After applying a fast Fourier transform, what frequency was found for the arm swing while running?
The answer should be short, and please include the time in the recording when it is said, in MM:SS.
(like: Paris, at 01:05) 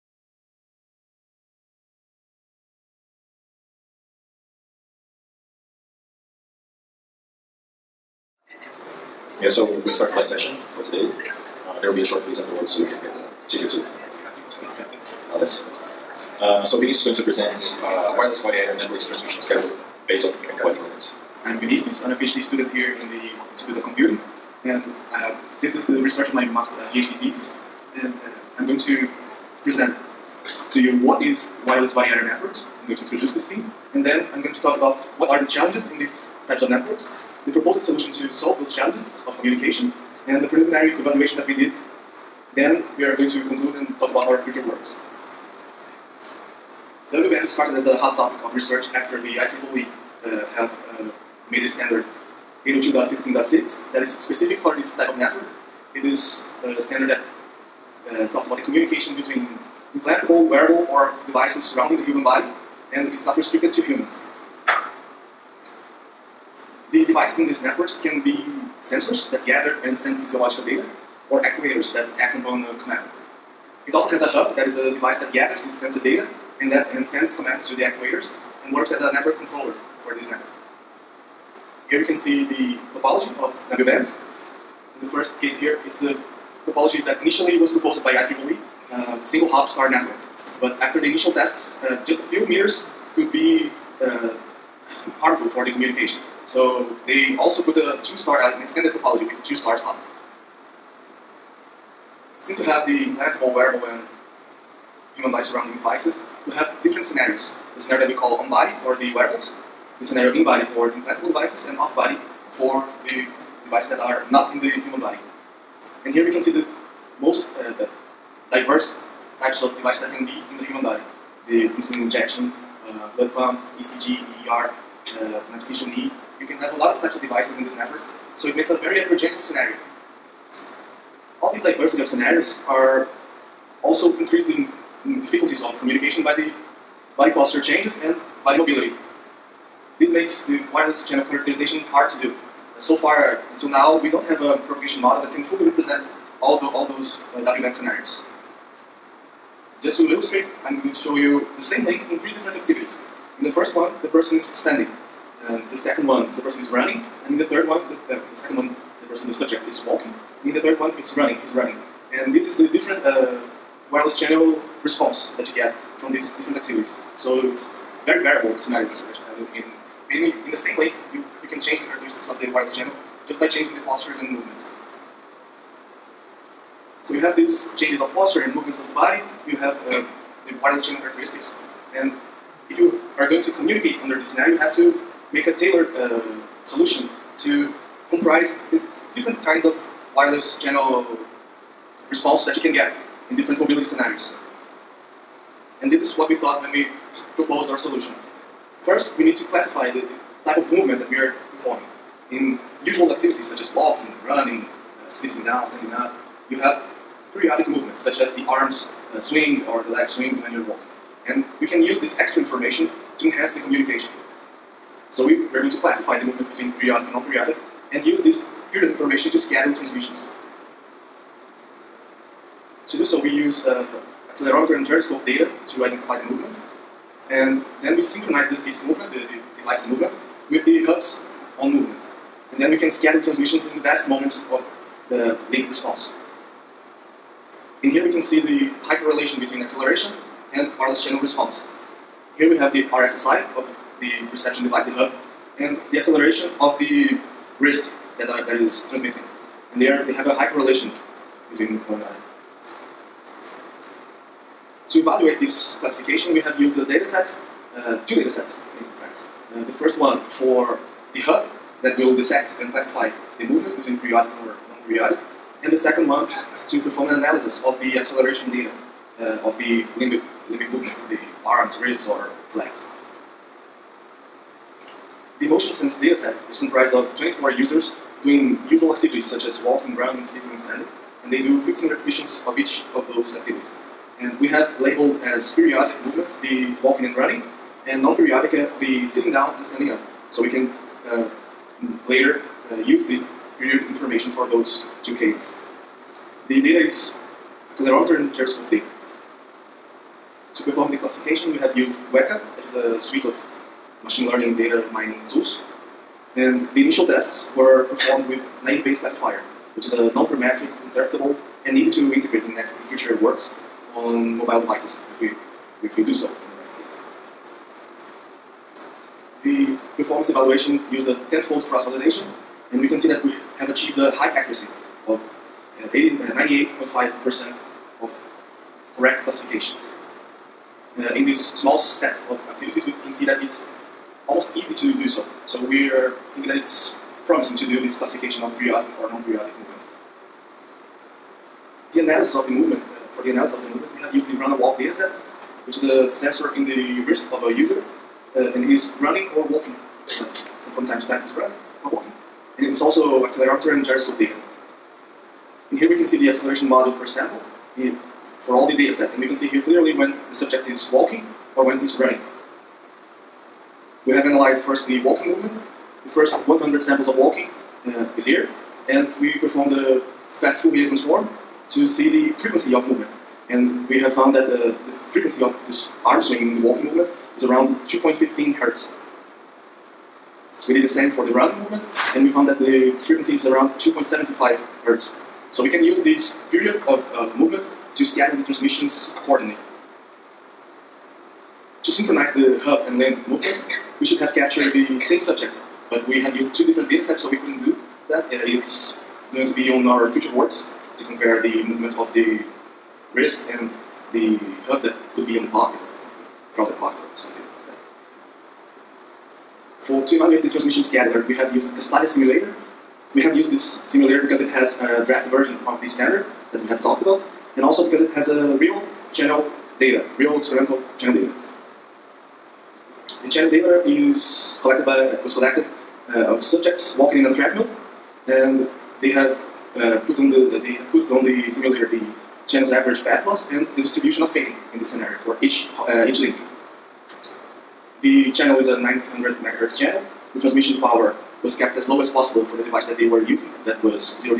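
2.75 hertz, at 06:23.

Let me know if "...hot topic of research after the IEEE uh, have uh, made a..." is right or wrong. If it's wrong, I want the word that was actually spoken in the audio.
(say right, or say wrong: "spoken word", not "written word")
right.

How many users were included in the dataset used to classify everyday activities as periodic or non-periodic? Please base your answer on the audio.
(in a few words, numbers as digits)
24.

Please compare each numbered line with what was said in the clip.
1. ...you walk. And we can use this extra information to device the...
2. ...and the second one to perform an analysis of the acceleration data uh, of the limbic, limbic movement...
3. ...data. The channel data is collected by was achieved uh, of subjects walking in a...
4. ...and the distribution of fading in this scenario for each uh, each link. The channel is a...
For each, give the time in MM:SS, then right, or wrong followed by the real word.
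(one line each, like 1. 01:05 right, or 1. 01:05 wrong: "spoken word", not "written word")
1. 03:30 wrong: "enhance", not "device"
2. 04:25 right
3. 07:01 wrong: "collected", not "achieved"
4. 07:13 right.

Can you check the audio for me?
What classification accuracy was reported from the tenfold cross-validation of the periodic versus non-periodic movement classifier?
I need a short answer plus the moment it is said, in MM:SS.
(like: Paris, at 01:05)
98.5%, at 05:25.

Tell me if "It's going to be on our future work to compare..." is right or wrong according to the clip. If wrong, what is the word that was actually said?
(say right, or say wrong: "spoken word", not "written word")
right.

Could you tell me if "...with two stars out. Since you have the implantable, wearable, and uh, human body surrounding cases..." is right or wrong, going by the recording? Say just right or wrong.
wrong.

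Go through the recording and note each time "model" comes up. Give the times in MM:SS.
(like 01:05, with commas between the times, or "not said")
02:25, 05:56.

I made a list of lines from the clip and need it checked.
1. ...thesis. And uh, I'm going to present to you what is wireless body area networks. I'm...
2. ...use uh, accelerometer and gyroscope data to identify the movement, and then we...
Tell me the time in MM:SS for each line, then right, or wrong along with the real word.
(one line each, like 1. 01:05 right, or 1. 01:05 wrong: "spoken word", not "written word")
1. 00:27 right
2. 03:43 right.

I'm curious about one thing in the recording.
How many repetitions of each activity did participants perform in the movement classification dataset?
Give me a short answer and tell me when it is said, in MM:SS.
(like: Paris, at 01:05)
15, at 04:41.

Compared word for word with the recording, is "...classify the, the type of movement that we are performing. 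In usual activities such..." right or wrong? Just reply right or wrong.
right.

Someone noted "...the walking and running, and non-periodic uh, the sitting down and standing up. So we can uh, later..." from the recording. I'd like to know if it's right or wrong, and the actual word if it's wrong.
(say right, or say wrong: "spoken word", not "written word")
right.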